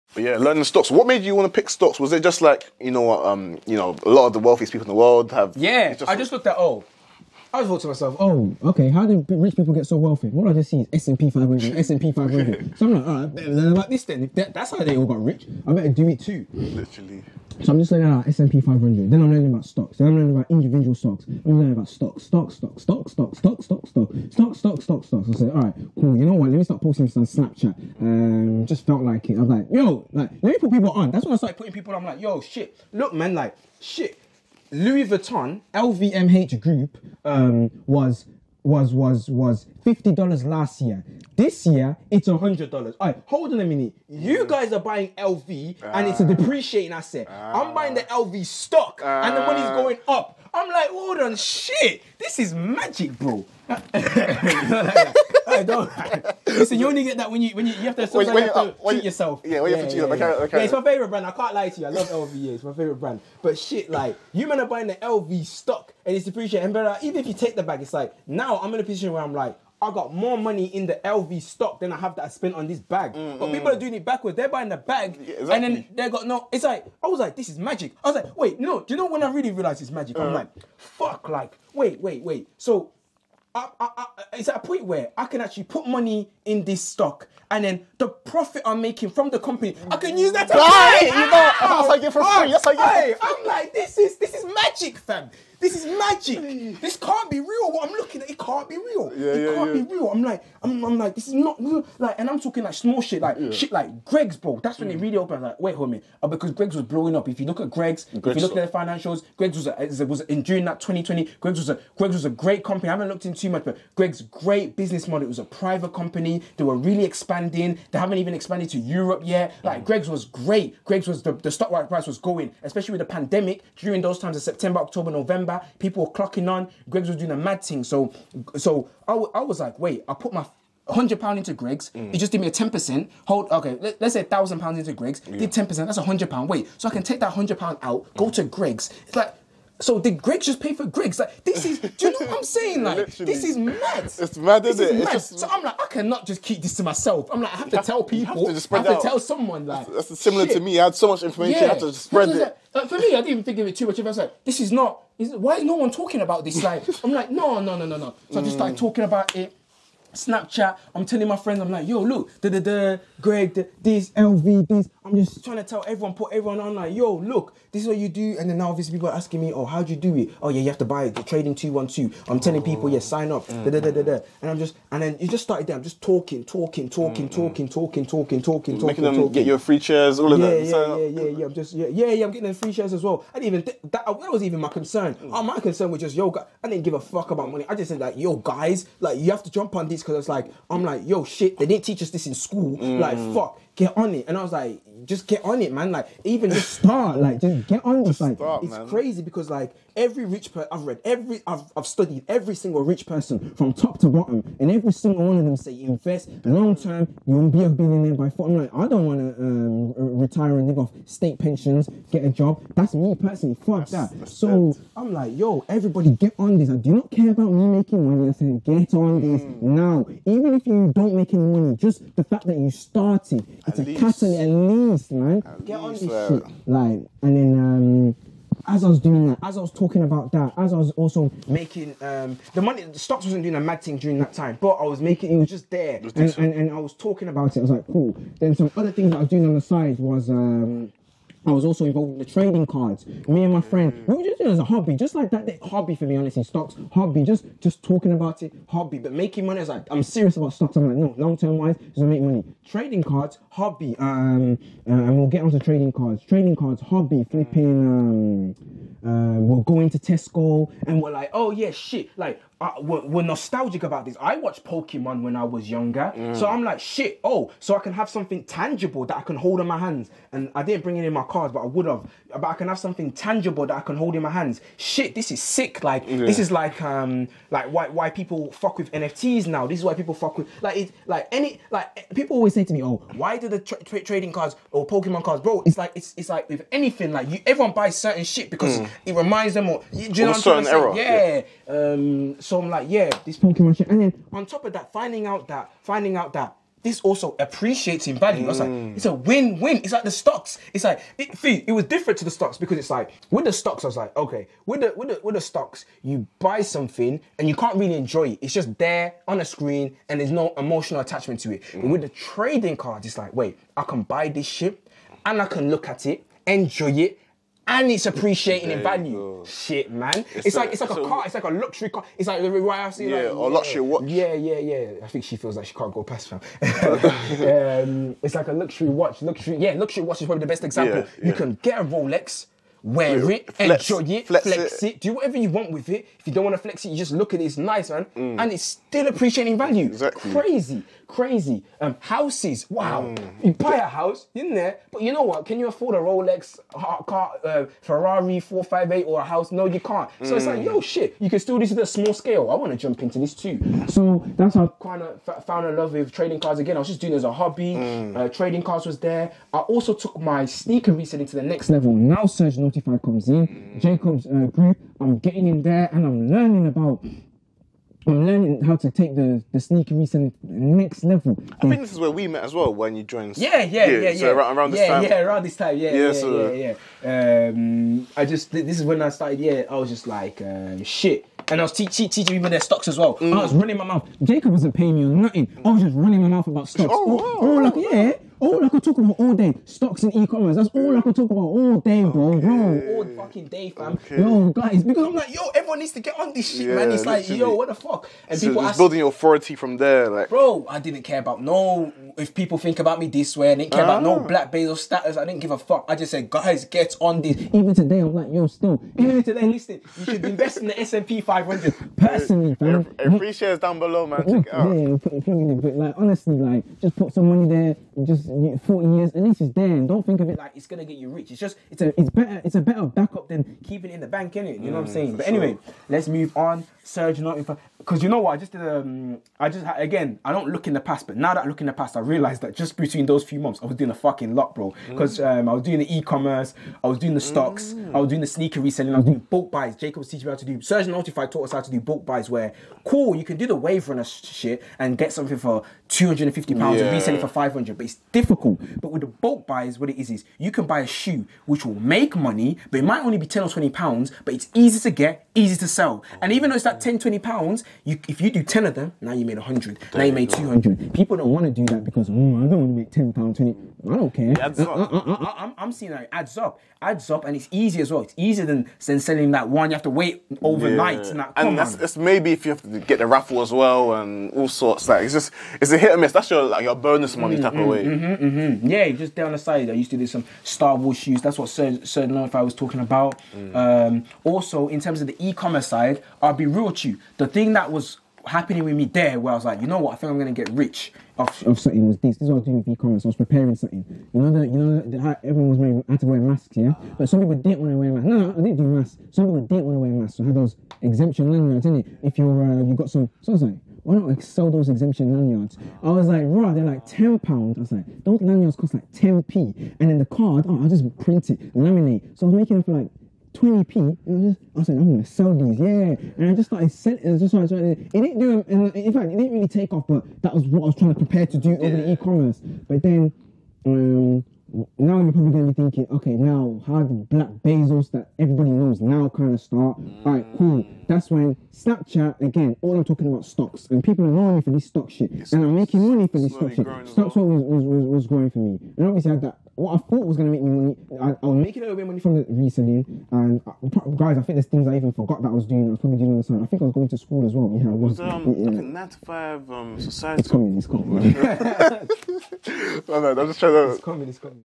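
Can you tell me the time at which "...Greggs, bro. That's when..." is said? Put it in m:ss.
1:44.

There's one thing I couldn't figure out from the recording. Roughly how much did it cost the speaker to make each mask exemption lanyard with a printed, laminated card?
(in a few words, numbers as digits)
20p.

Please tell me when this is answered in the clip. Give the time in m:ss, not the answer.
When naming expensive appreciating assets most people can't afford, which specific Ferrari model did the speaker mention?
5:47.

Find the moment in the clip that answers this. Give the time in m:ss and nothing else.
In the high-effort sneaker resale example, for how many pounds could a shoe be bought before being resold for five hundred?
7:25.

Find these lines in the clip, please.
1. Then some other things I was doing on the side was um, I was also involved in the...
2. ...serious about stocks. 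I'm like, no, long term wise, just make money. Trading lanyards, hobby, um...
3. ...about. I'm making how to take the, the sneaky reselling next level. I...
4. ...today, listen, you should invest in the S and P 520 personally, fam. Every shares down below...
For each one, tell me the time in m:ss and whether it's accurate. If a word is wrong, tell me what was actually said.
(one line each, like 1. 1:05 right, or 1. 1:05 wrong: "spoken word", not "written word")
1. 3:58 right
2. 4:10 wrong: "cards", not "lanyards"
3. 6:06 wrong: "learning", not "making"
4. 6:49 wrong: "500", not "520".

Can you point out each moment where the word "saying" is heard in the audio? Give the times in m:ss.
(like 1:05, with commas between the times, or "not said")
2:22, 7:04.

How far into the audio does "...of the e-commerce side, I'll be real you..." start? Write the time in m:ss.
8:05.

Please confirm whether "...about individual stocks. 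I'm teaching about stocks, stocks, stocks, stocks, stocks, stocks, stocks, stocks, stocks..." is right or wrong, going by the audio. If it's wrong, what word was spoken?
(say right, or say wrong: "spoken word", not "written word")
wrong: "learning", not "teaching".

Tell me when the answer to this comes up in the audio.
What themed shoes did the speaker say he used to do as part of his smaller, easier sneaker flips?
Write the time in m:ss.
8:00.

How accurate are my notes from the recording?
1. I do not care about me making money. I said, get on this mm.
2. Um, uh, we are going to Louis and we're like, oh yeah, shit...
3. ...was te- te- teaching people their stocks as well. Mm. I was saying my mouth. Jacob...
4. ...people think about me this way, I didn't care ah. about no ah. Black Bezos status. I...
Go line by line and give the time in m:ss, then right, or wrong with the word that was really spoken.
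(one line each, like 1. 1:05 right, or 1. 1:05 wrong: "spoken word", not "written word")
1. 3:36 right
2. 4:18 wrong: "Tesco", not "Louis"
3. 6:21 wrong: "running", not "saying"
4. 6:42 right.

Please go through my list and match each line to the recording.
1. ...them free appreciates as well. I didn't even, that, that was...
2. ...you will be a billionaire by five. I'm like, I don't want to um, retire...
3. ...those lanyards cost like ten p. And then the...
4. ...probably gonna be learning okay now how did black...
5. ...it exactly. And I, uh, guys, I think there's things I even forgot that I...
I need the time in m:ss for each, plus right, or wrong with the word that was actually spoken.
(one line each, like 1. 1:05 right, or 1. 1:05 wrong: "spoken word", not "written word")
1. 3:02 wrong: "shares", not "appreciates"
2. 3:27 wrong: "four", not "five"
3. 8:28 right
4. 8:45 wrong: "thinking", not "learning"
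5. 9:02 wrong: "recently", not "exactly".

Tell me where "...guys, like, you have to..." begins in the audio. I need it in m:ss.
3:08.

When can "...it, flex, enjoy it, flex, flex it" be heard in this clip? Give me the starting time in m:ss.
5:33.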